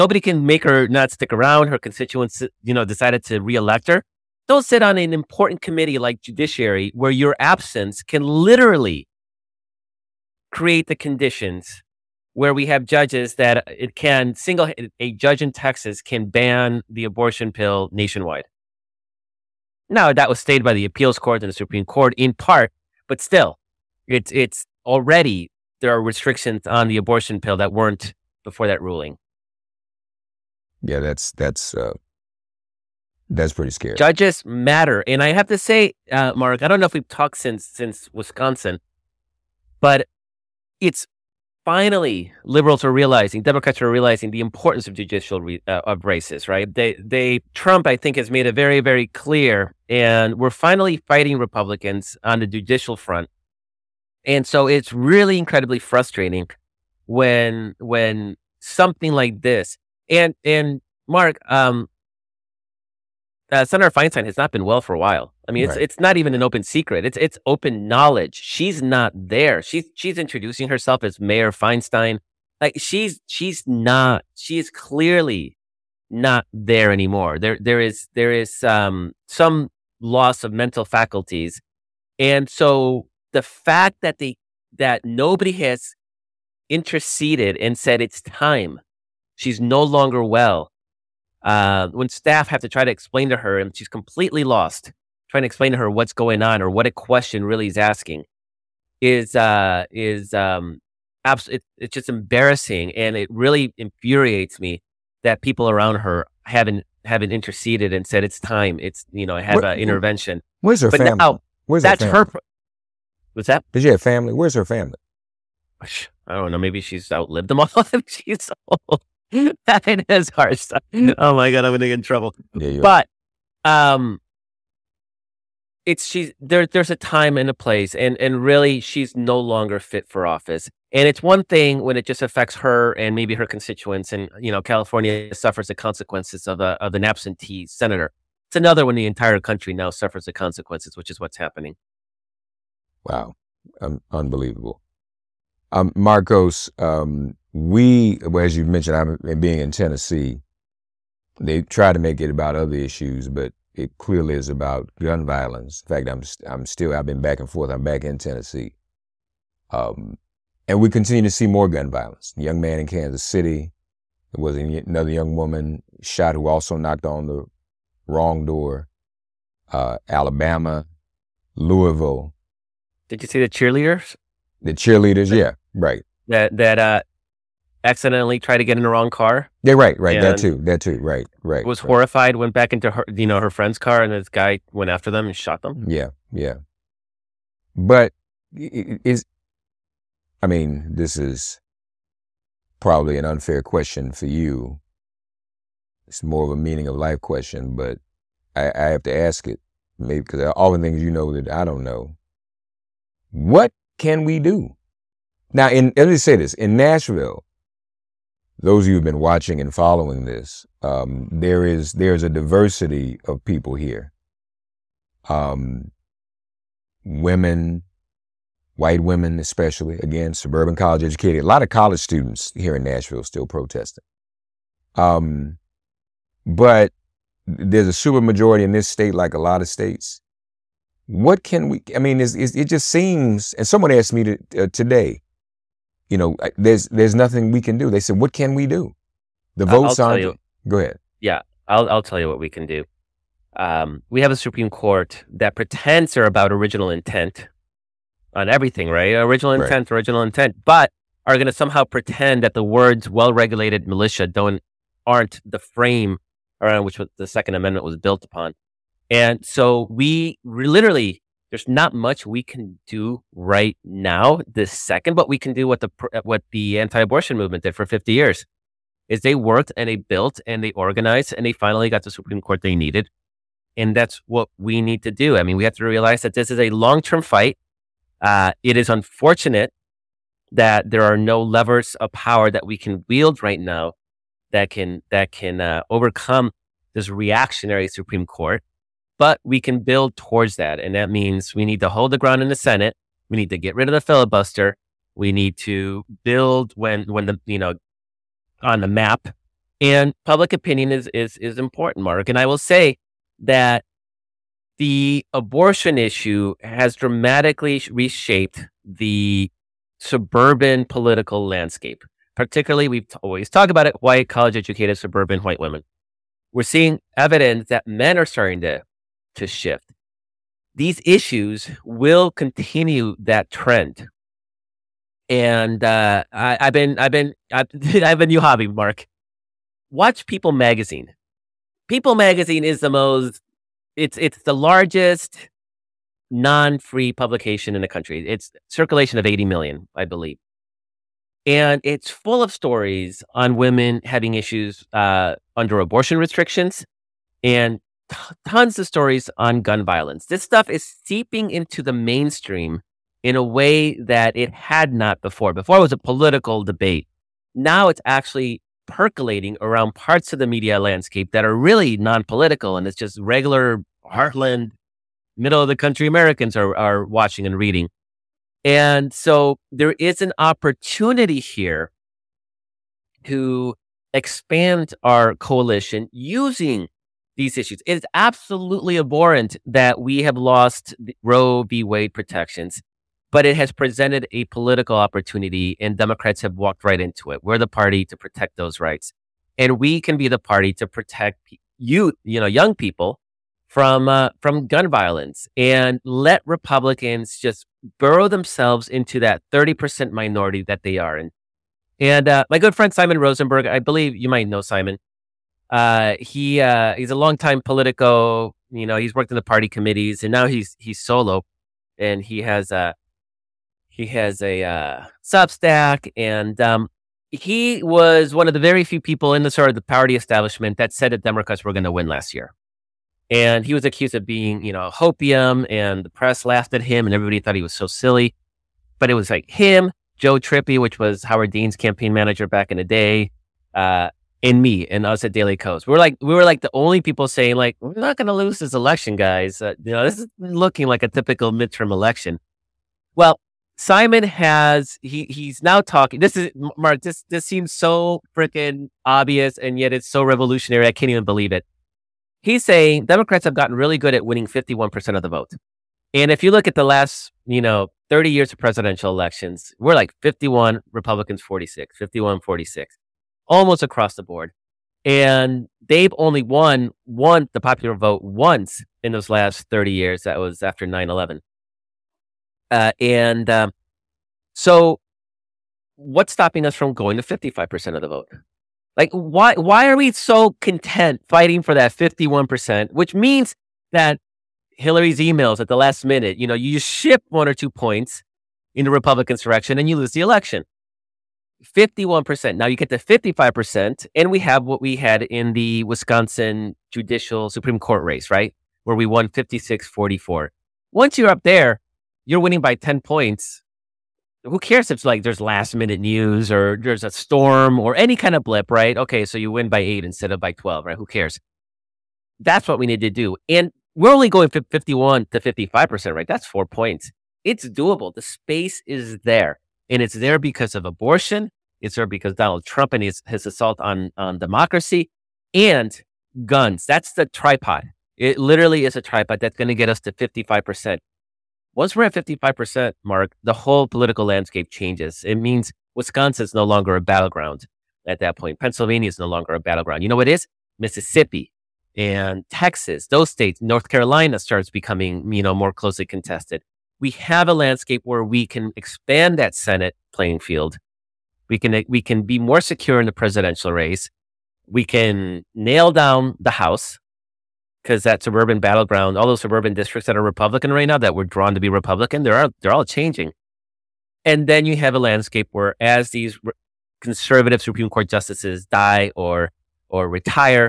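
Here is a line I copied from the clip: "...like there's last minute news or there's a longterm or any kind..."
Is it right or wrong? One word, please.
wrong.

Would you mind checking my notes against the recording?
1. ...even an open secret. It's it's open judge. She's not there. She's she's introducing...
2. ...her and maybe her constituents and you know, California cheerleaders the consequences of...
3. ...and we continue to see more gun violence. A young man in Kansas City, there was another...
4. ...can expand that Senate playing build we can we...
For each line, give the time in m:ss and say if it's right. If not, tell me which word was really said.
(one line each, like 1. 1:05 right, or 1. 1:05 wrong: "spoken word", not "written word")
1. 1:06 wrong: "knowledge", not "judge"
2. 2:12 wrong: "suffers", not "cheerleaders"
3. 2:40 right
4. 9:08 wrong: "field", not "build".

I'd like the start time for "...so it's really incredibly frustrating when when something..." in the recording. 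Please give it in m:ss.
0:54.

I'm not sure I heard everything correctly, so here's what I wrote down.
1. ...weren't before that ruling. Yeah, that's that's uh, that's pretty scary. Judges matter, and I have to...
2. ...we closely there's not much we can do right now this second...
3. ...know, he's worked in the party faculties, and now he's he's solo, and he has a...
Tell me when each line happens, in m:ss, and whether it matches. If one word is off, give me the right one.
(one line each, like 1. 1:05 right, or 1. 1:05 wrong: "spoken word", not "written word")
1. 0:27 right
2. 4:19 wrong: "literally", not "closely"
3. 6:48 wrong: "committees", not "faculties".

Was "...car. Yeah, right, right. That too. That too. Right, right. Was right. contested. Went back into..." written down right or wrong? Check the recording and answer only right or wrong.
wrong.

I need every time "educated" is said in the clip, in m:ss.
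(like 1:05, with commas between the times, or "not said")
3:41, 5:14.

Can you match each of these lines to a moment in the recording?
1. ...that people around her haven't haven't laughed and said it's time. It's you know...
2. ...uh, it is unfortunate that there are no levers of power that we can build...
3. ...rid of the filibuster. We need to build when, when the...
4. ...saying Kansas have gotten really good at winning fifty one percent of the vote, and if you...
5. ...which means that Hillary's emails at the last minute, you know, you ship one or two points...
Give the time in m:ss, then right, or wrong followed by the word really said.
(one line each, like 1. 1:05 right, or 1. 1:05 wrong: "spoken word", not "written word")
1. 1:45 wrong: "interceded", not "laughed"
2. 4:38 wrong: "wield", not "build"
3. 4:53 right
4. 7:32 wrong: "Democrats", not "Kansas"
5. 8:02 right.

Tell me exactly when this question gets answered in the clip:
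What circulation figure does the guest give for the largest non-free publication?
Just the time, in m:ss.
5:39.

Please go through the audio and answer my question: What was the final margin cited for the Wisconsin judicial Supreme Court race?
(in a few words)
56-44.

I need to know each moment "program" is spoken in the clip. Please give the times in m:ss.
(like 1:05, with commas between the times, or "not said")
not said.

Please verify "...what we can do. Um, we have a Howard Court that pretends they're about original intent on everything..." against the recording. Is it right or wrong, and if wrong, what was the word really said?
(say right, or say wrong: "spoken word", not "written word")
wrong: "Supreme", not "Howard".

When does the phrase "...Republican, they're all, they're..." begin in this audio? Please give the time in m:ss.
9:21.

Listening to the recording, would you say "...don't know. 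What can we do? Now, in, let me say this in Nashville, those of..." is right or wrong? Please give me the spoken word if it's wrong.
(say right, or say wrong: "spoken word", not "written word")
right.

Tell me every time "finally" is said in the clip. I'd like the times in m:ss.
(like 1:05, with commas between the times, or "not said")
0:41, 0:50, 4:31.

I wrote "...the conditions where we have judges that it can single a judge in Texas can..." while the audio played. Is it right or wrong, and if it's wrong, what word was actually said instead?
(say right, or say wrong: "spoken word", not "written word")
right.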